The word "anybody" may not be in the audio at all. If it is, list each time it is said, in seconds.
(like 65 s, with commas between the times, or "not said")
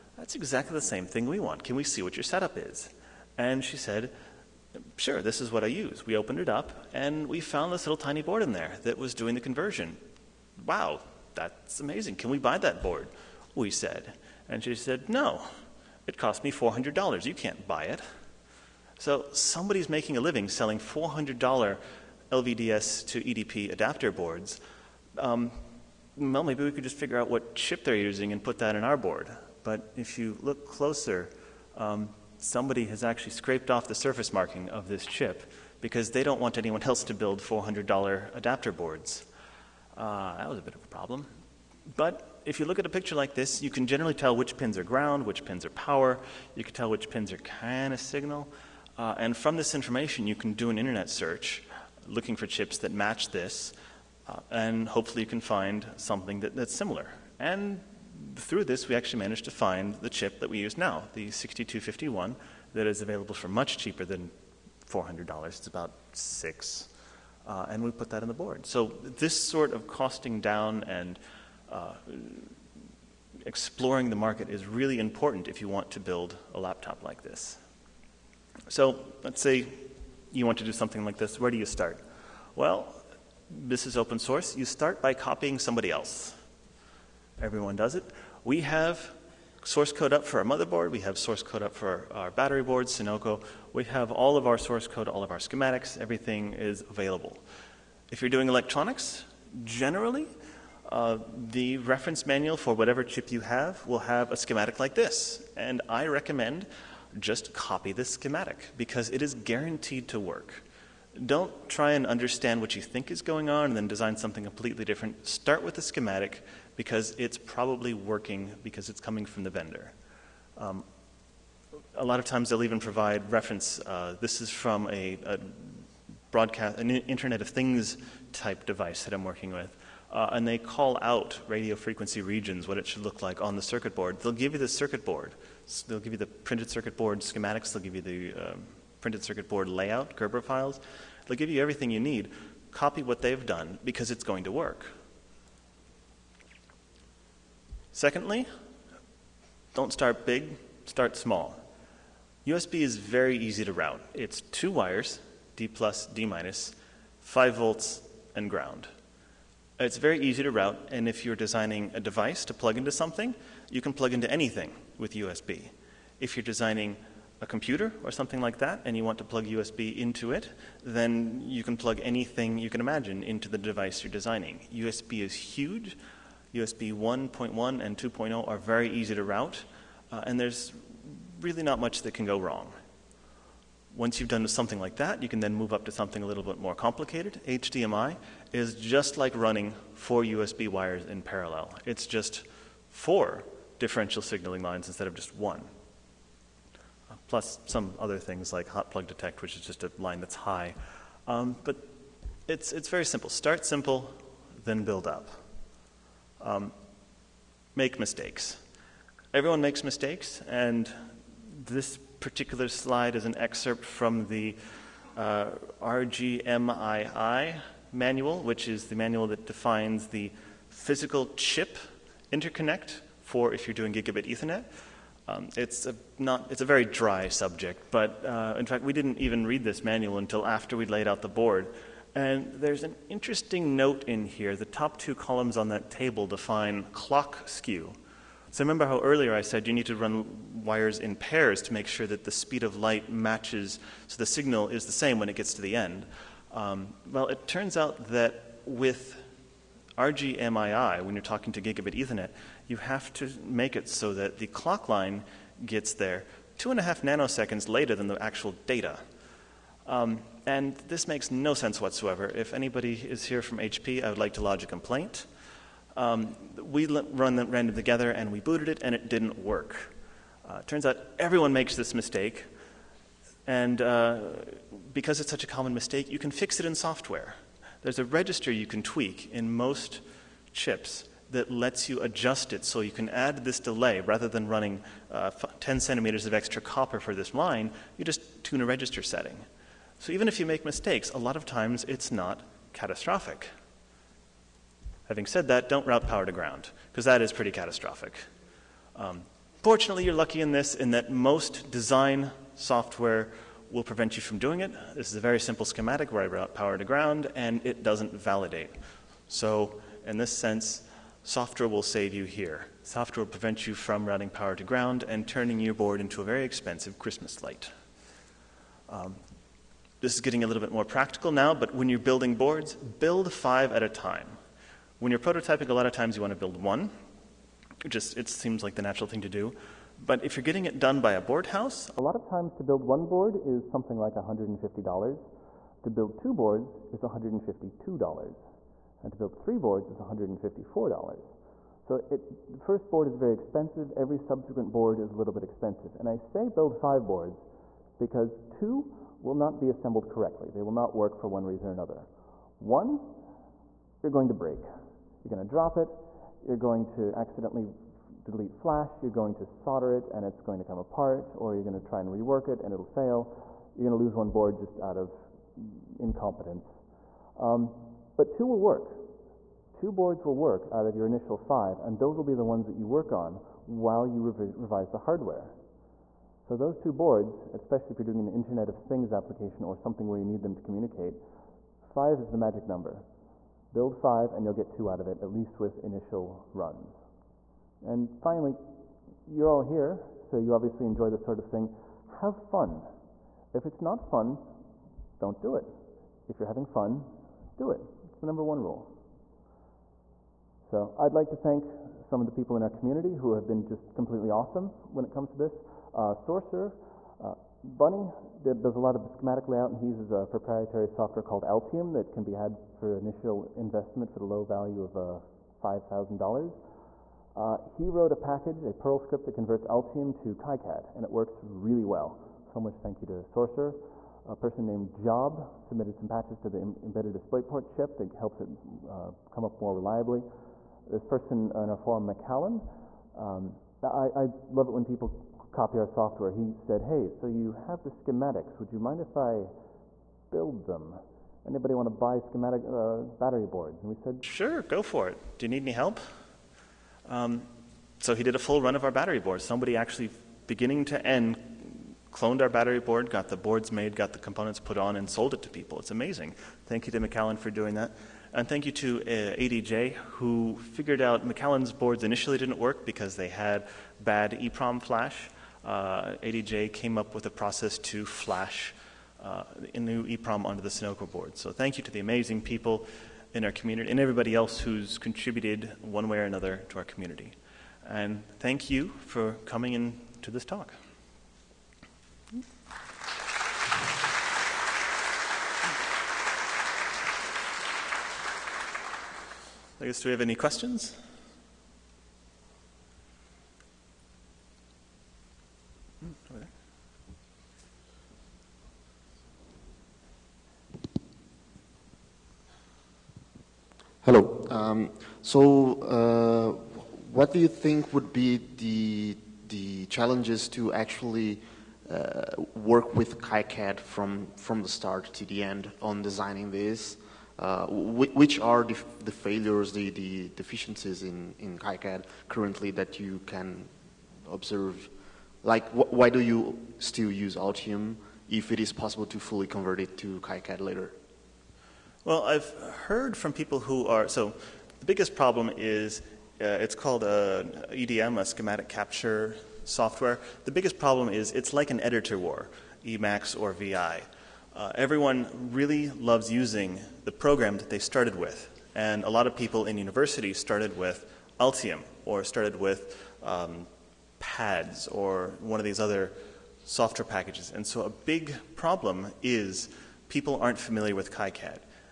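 262 s, 441 s.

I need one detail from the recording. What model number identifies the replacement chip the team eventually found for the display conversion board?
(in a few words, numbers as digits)
6251.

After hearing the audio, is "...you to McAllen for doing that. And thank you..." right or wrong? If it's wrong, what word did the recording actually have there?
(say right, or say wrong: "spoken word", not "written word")
right.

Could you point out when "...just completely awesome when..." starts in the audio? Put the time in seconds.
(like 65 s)
403 s.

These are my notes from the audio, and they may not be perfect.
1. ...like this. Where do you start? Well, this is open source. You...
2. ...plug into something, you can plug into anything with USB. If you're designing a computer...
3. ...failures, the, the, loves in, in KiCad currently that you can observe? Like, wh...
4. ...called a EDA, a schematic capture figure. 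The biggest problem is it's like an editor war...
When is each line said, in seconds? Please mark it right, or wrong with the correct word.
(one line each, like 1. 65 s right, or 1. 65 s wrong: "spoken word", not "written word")
1. 81 s right
2. 162 s right
3. 519 s wrong: "deficiencies", not "loves"
4. 536 s wrong: "software", not "figure".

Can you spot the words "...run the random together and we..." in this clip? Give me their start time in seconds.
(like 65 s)
266 s.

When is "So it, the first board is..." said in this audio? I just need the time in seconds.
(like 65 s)
341 s.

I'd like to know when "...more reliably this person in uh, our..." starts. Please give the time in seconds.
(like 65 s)
429 s.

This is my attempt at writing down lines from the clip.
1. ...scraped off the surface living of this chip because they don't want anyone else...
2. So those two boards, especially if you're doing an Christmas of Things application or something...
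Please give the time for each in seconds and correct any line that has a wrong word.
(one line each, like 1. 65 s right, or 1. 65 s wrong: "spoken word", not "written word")
1. 33 s wrong: "marking", not "living"
2. 376 s wrong: "Internet", not "Christmas".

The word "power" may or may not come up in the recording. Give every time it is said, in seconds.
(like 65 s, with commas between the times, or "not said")
45 s, 296 s, 306 s, 314 s.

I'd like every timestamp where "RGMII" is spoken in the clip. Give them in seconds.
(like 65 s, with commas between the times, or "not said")
215 s, 249 s.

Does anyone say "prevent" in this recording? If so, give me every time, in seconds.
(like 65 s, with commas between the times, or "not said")
303 s, 313 s.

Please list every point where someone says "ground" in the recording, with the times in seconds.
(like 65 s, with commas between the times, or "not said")
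44 s, 158 s, 296 s, 306 s, 314 s.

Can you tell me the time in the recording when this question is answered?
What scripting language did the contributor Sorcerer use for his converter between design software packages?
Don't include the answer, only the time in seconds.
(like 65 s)
418 s.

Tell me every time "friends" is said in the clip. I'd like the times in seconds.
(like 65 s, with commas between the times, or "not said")
not said.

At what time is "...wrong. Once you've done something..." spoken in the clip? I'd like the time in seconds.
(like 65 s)
182 s.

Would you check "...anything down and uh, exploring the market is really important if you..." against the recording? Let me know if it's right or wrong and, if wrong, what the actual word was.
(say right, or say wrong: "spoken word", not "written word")
wrong: "costing", not "anything".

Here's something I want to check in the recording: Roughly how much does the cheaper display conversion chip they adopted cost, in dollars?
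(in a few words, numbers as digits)
6.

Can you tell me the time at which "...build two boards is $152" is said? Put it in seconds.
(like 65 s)
335 s.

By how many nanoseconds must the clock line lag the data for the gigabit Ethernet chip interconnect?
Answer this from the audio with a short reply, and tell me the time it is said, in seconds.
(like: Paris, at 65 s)
2.5, at 256 s.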